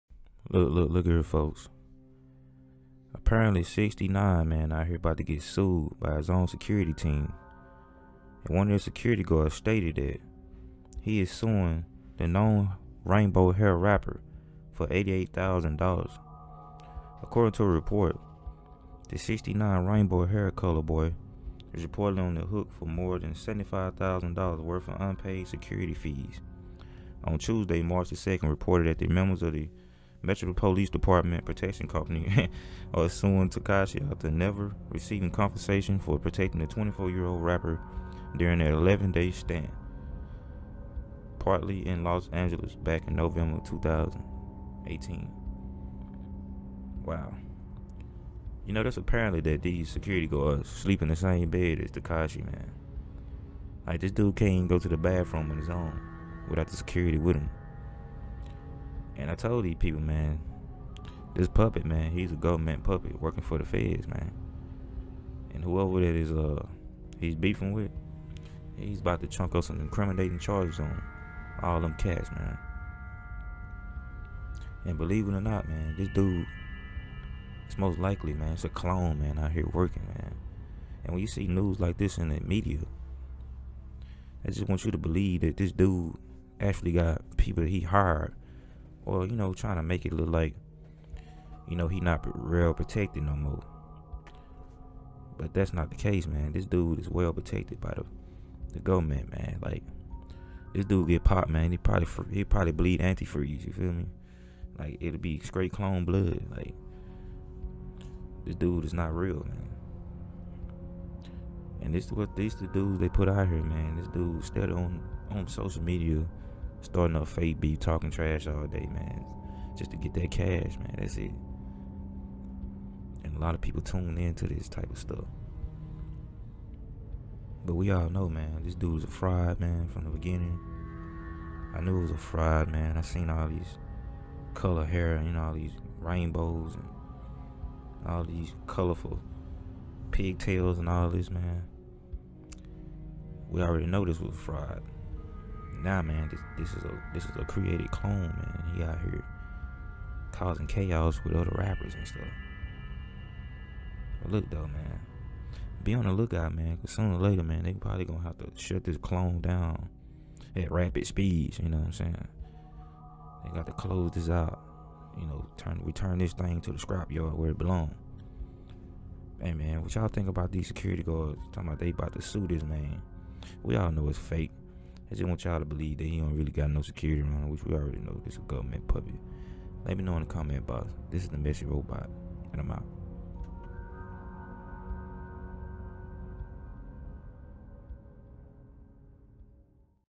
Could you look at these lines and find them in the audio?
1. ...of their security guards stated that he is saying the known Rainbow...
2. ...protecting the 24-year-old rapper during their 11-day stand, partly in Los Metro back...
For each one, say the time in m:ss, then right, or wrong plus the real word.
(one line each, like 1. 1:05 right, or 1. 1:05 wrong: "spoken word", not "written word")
1. 0:08 wrong: "suing", not "saying"
2. 0:36 wrong: "Angeles", not "Metro".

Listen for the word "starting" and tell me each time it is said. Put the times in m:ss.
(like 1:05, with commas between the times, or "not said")
1:56.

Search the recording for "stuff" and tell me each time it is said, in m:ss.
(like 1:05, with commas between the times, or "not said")
2:04, 2:32.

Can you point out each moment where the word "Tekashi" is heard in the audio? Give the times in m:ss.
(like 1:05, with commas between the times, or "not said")
0:33, 0:51.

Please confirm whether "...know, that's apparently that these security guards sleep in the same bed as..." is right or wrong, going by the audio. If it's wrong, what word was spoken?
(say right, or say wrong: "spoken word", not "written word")
right.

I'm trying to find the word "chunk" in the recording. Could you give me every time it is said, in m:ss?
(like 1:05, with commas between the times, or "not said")
1:09.